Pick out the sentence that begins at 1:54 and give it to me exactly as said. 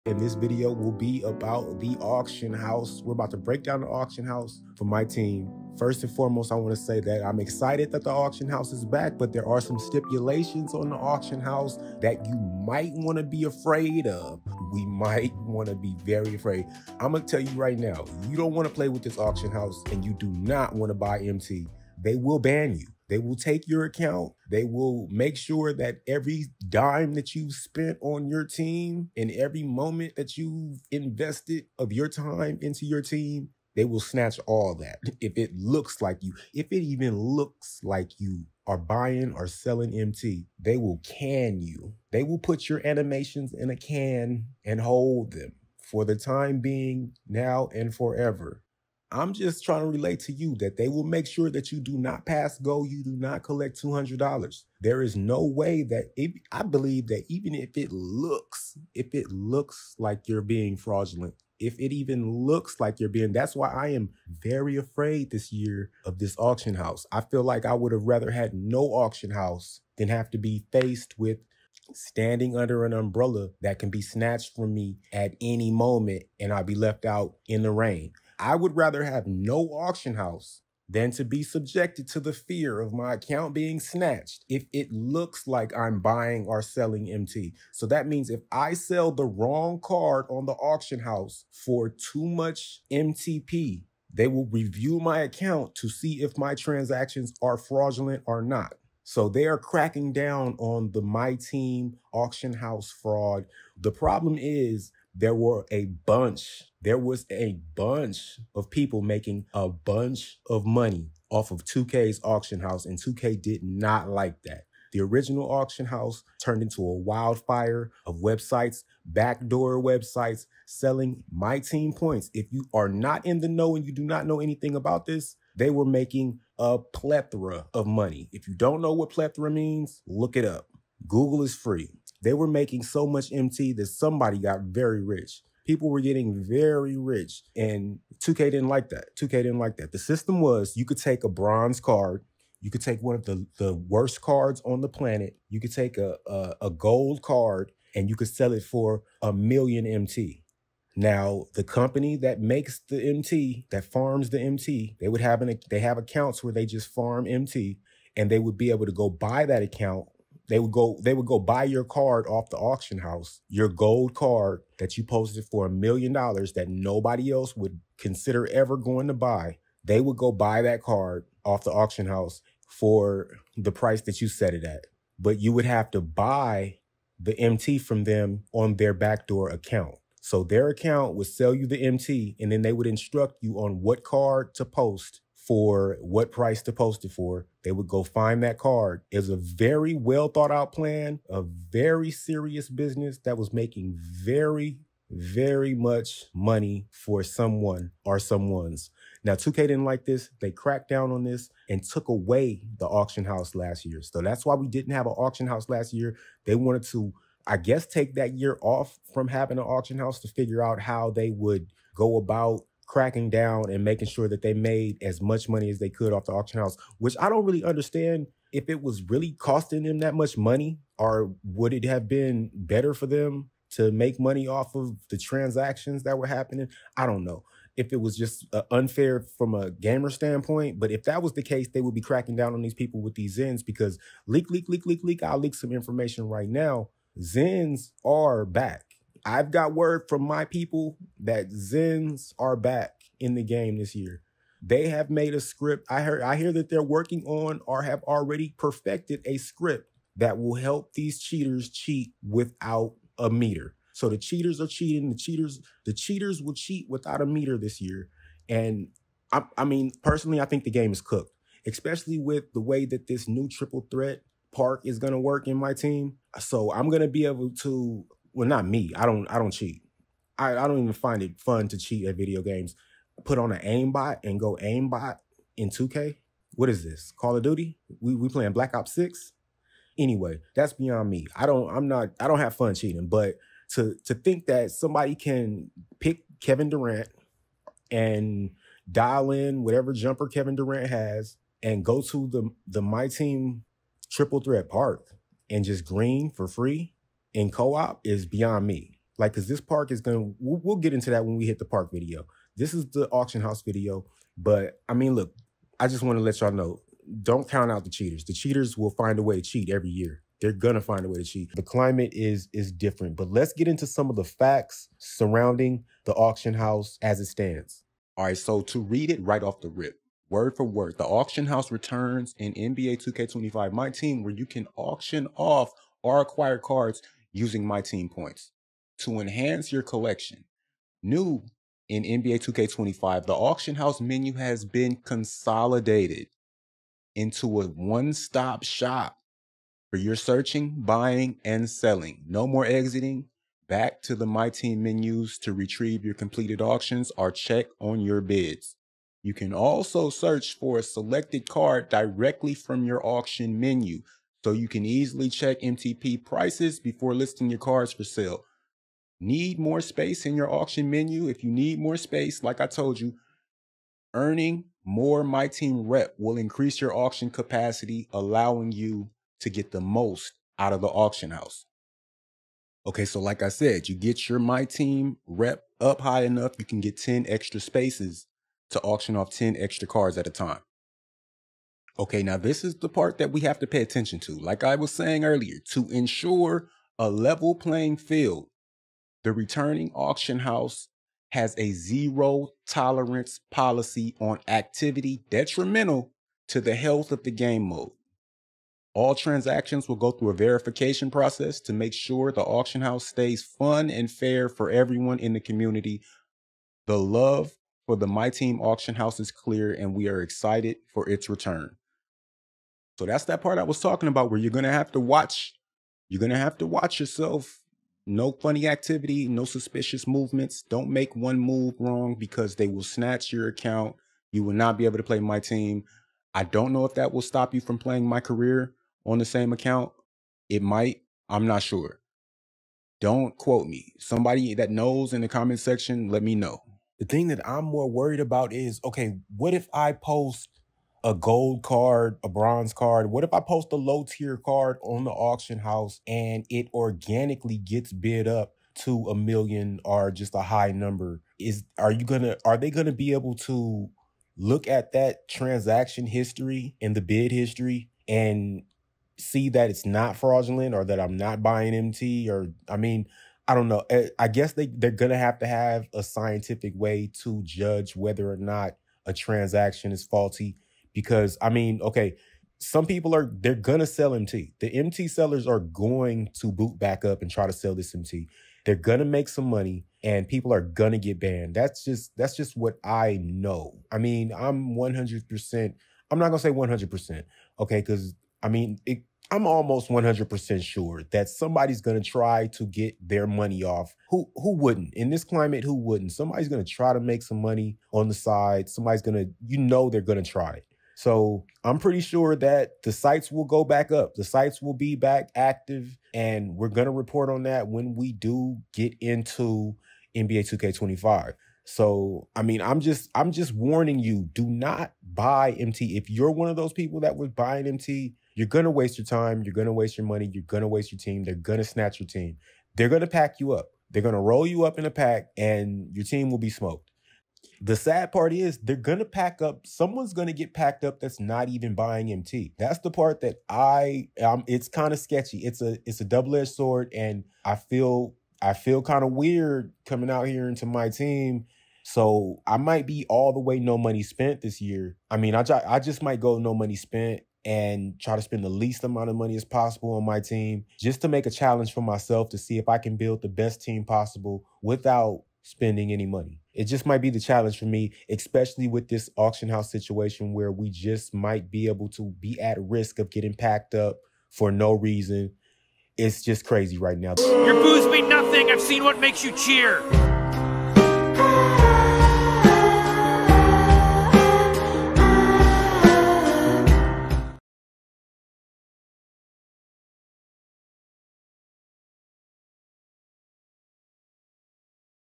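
The original auction house turned into a wildfire of websites, backdoor websites selling my team points.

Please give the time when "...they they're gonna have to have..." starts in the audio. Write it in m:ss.
7:44.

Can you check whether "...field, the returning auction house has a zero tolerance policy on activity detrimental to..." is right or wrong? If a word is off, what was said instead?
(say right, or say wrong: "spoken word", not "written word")
right.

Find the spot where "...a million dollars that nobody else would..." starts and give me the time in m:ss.
2:45.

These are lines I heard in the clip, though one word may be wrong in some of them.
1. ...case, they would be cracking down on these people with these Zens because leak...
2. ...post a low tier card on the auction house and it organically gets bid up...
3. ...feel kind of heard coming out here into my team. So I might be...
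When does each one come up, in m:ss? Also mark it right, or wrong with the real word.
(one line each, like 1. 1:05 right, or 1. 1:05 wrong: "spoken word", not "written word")
1. 3:51 right
2. 7:23 right
3. 8:58 wrong: "weird", not "heard".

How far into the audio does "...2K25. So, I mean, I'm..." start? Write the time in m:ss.
8:30.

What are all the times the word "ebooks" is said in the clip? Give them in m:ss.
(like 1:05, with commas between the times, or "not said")
not said.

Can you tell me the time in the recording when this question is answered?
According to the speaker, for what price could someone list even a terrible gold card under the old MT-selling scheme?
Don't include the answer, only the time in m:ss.
2:29.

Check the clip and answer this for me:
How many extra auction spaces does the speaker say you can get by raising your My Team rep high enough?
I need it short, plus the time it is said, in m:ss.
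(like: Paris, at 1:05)
10, at 6:16.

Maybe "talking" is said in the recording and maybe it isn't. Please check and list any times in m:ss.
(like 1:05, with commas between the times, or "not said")
6:53.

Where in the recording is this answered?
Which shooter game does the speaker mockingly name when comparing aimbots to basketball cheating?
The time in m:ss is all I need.
4:38.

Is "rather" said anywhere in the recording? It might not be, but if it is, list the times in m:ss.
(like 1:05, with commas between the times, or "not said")
1:08, 1:18.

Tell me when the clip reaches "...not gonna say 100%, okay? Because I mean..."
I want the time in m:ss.
8:06.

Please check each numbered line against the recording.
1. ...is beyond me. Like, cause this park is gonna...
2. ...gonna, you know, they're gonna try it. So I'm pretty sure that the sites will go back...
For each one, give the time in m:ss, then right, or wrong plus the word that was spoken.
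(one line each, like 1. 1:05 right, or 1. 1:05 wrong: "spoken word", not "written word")
1. 4:58 right
2. 8:19 right.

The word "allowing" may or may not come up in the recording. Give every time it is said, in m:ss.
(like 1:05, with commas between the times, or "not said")
6:08.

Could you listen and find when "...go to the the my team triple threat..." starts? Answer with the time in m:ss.
4:51.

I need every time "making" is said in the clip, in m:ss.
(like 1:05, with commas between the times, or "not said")
1:49, 2:05, 2:12, 3:13, 3:33.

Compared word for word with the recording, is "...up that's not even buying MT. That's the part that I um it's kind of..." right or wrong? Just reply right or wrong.
right.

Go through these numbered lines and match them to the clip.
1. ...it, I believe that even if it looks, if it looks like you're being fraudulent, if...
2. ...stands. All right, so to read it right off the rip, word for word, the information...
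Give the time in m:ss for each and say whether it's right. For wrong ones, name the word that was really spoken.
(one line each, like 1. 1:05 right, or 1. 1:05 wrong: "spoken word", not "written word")
1. 0:56 right
2. 5:17 wrong: "auction", not "information".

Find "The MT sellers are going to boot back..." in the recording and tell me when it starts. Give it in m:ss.
7:54.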